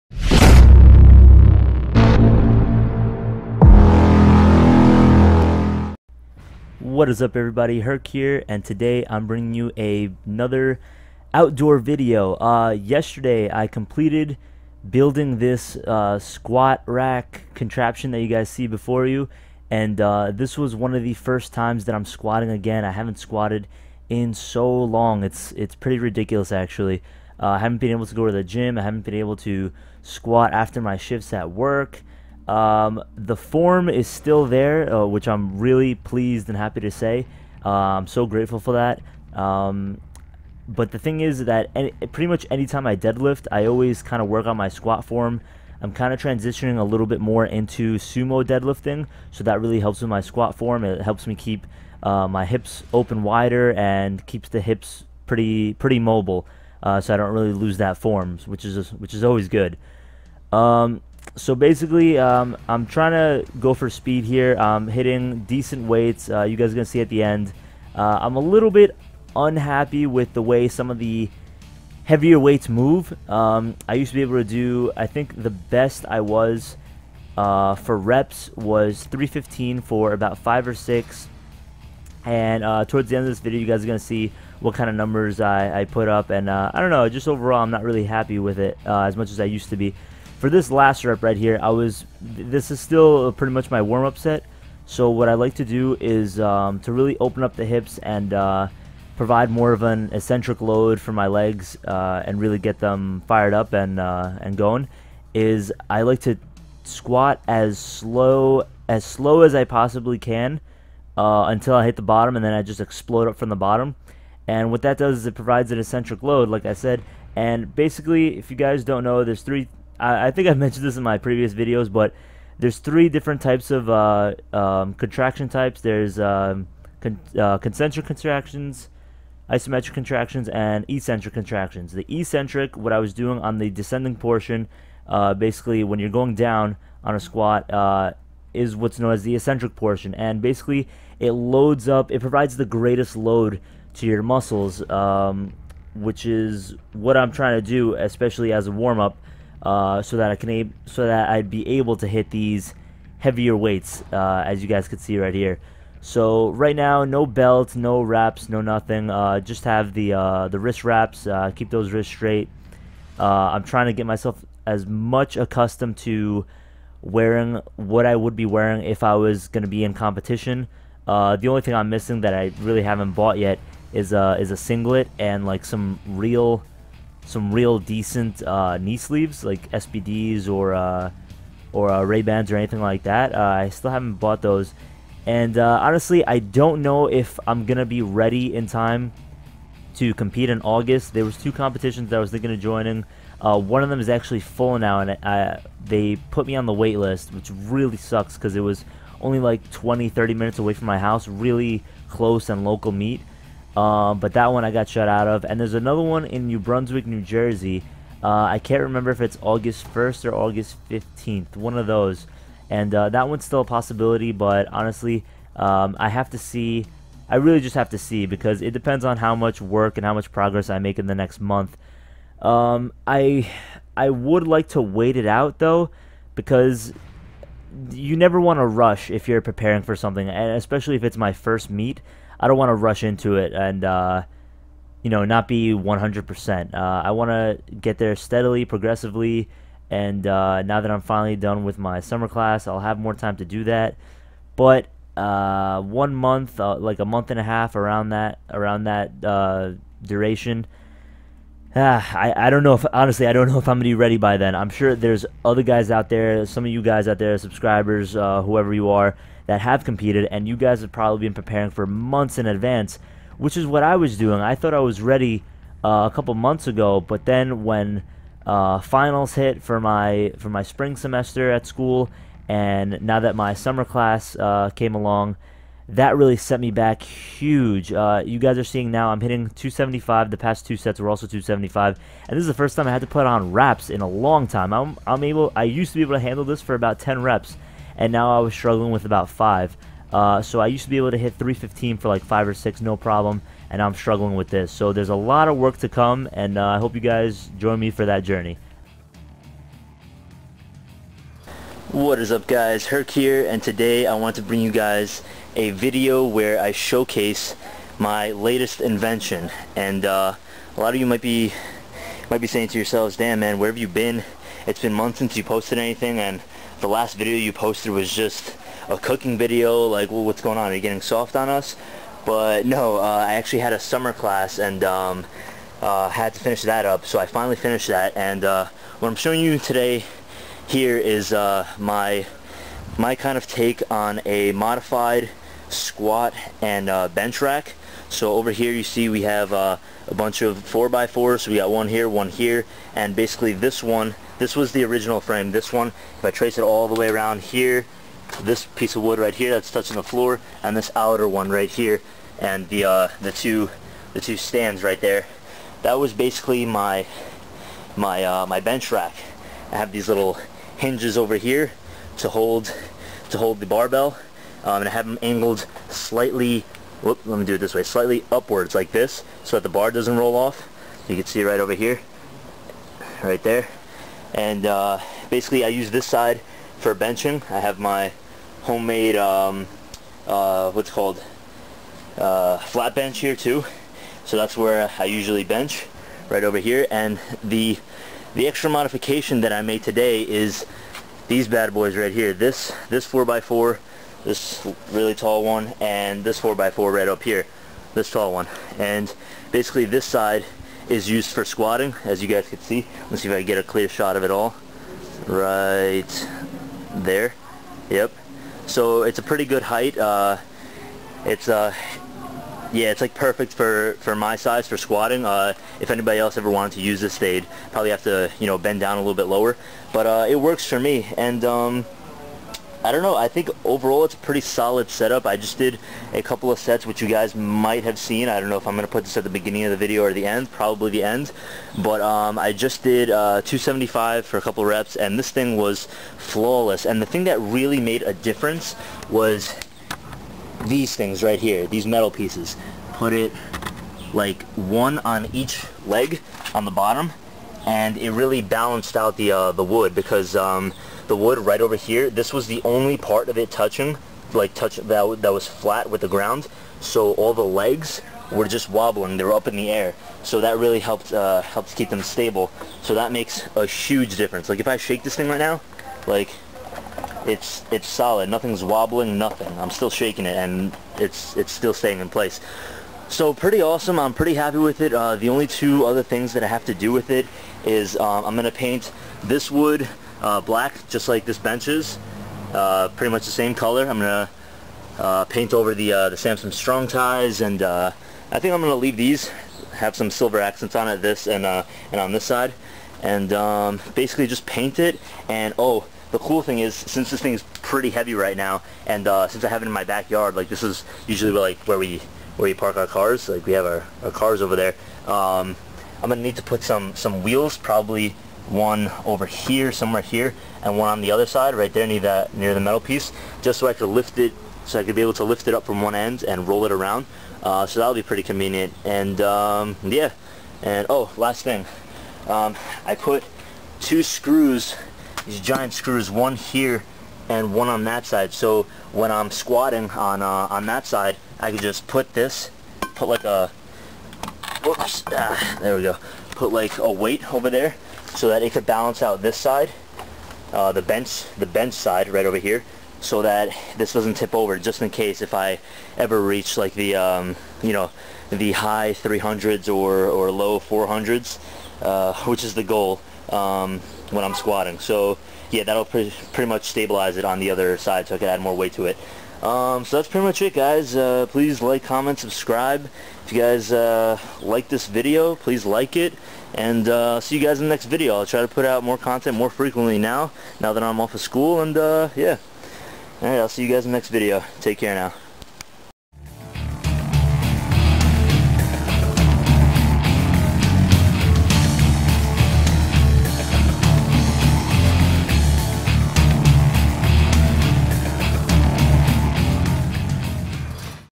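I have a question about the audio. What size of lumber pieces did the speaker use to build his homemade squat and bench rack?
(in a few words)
4x4.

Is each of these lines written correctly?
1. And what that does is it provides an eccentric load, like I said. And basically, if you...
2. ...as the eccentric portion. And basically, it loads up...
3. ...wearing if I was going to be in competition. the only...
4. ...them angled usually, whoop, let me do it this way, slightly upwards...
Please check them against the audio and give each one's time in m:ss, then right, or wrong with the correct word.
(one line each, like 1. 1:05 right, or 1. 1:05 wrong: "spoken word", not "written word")
1. 1:54 right
2. 2:19 right
3. 2:48 right
4. 6:05 wrong: "slightly", not "usually".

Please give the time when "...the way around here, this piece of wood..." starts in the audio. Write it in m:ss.
5:46.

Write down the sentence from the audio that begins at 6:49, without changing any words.
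Uh, it's uh, yeah, it's like perfect for, for my size for squatting.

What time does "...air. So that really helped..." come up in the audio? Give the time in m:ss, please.
7:39.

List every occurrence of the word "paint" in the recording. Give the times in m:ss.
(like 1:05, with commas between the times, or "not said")
7:58, 8:05, 8:14.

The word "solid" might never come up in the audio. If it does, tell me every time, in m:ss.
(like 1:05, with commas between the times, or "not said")
7:04, 7:47.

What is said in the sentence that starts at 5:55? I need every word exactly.
That was basically my, my, uh, my bench rack.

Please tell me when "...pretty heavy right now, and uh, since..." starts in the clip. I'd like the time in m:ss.
8:17.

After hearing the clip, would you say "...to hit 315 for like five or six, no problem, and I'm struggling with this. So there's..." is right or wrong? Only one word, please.
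right.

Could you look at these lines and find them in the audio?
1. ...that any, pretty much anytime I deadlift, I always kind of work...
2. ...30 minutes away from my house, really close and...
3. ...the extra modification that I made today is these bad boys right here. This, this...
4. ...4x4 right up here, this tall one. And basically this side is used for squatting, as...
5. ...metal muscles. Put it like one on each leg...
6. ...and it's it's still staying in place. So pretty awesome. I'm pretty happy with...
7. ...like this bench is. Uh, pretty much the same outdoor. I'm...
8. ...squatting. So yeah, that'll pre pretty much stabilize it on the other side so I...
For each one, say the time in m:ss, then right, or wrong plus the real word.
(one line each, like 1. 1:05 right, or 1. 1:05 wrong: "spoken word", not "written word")
1. 0:41 right
2. 3:20 right
3. 6:28 right
4. 6:36 right
5. 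7:21 wrong: "pieces", not "muscles"
6. 7:50 right
7. 8:01 wrong: "color", not "outdoor"
8. 9:14 right.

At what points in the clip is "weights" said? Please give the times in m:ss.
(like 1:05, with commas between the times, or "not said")
1:05, 1:12, 2:33, 8:56, 9:18.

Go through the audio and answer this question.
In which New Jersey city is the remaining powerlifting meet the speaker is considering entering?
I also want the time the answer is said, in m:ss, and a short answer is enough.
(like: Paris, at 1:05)
New Brunswick, at 3:26.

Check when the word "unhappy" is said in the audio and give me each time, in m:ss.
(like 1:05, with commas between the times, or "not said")
1:09.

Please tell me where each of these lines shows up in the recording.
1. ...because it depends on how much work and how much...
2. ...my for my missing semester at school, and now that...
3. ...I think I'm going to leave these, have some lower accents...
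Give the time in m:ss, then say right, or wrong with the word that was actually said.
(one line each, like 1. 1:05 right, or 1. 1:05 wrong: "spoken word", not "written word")
1. 3:38 right
2. 4:29 wrong: "spring", not "missing"
3. 8:08 wrong: "silver", not "lower".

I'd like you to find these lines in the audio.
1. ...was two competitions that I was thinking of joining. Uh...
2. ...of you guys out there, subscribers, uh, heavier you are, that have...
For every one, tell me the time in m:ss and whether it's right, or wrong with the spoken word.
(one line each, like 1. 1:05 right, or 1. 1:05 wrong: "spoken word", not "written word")
1. 3:11 right
2. 4:16 wrong: "whoever", not "heavier".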